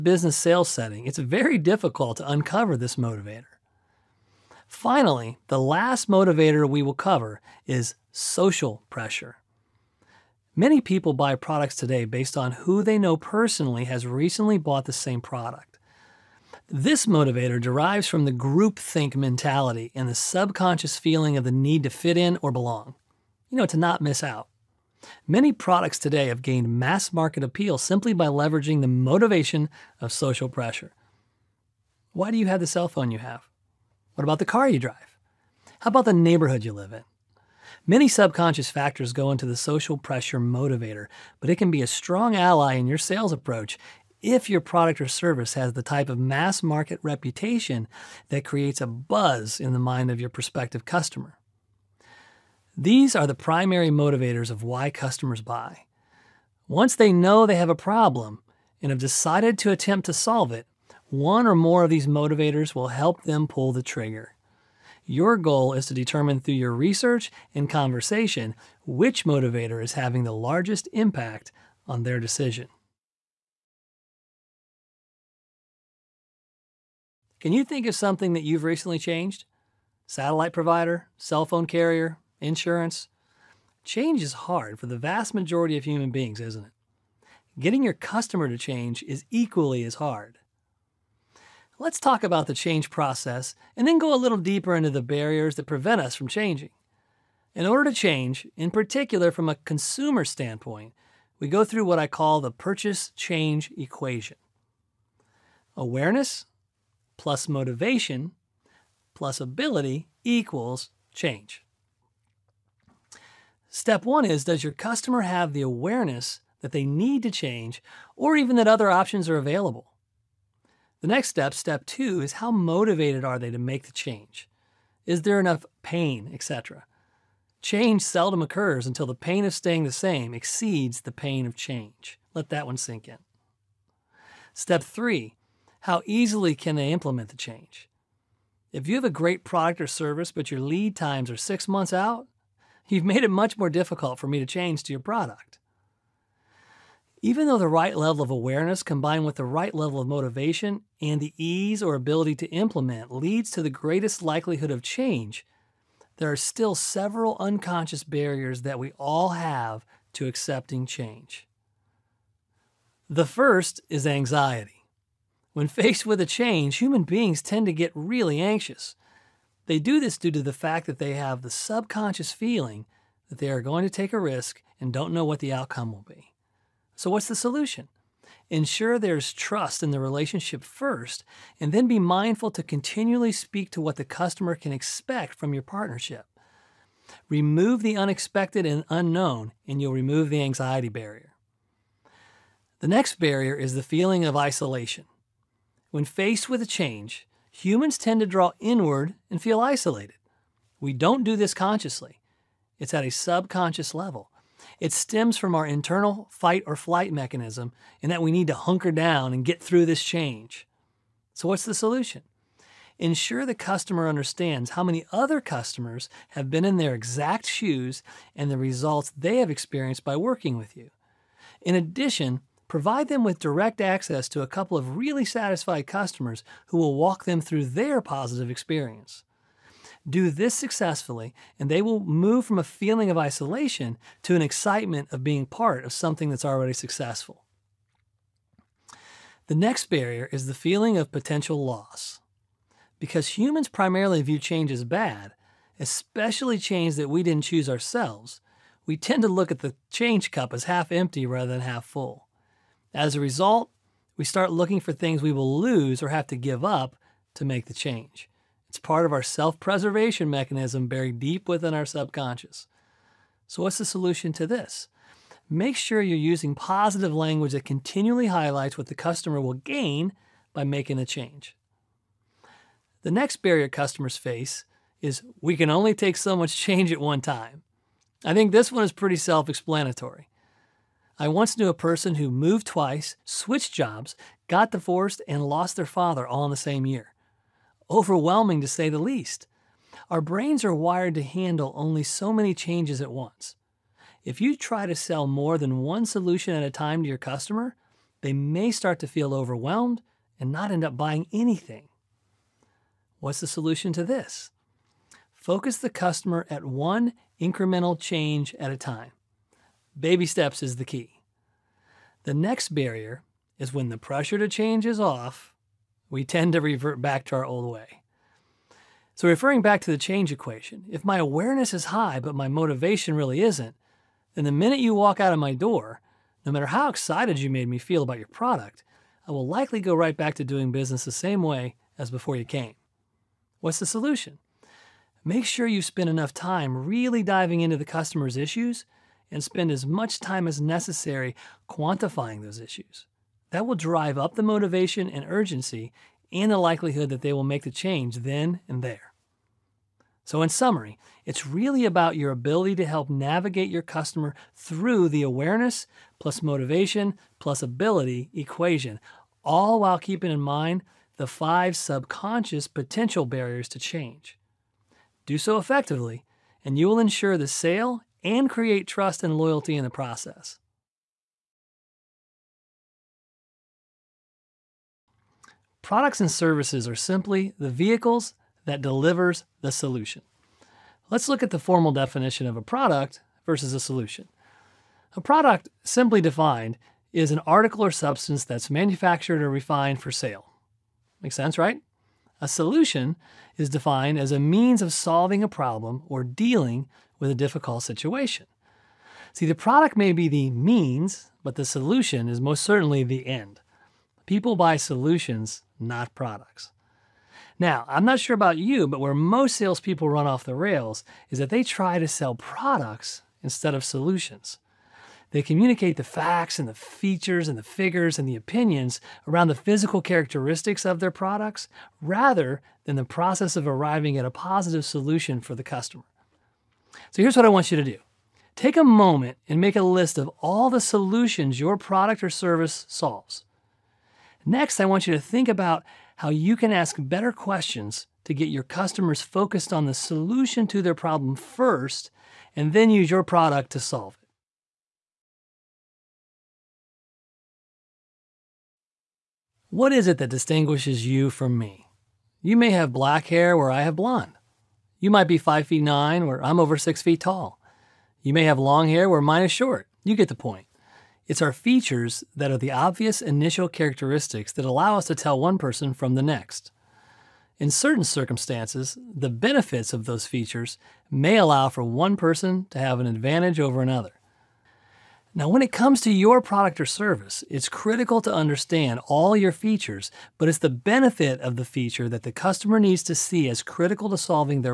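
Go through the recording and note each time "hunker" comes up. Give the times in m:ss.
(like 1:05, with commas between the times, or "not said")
3:28.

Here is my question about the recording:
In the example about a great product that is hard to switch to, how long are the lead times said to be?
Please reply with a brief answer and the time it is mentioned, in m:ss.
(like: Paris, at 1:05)
6 months, at 2:21.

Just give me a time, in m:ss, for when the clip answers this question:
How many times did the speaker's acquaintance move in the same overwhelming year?
4:42.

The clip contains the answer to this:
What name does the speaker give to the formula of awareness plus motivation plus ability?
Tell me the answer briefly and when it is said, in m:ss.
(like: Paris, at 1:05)
Purchase change equation, at 1:42.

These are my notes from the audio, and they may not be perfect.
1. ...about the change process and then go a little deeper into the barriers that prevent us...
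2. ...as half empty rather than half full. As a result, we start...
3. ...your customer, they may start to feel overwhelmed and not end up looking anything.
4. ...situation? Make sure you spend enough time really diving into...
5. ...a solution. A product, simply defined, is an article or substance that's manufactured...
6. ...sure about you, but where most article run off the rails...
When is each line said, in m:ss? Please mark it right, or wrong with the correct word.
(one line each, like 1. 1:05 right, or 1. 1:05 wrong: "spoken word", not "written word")
1. 1:32 right
2. 4:10 right
3. 4:57 wrong: "buying", not "looking"
4. 5:33 wrong: "solution", not "situation"
5. 6:23 right
6. 6:48 wrong: "salespeople", not "article".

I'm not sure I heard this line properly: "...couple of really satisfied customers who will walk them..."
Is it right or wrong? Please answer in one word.
right.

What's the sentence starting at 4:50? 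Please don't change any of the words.
Our brains are wired to handle only so many changes at once.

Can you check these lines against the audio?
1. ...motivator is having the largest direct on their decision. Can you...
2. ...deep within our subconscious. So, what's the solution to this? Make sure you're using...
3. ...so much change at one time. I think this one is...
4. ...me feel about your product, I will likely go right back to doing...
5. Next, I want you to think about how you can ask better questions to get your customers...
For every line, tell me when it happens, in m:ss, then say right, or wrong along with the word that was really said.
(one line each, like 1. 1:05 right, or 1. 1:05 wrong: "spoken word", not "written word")
1. 1:09 wrong: "impact", not "direct"
2. 4:21 right
3. 4:36 right
4. 5:27 right
5. 7:14 right.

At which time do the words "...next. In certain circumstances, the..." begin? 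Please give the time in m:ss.
7:46.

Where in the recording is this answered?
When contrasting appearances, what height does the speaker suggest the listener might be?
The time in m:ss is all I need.
7:35.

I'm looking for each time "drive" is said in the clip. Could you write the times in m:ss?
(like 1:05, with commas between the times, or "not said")
0:34, 5:43.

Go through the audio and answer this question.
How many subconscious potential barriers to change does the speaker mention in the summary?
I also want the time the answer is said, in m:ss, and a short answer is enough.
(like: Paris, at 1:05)
5, at 6:01.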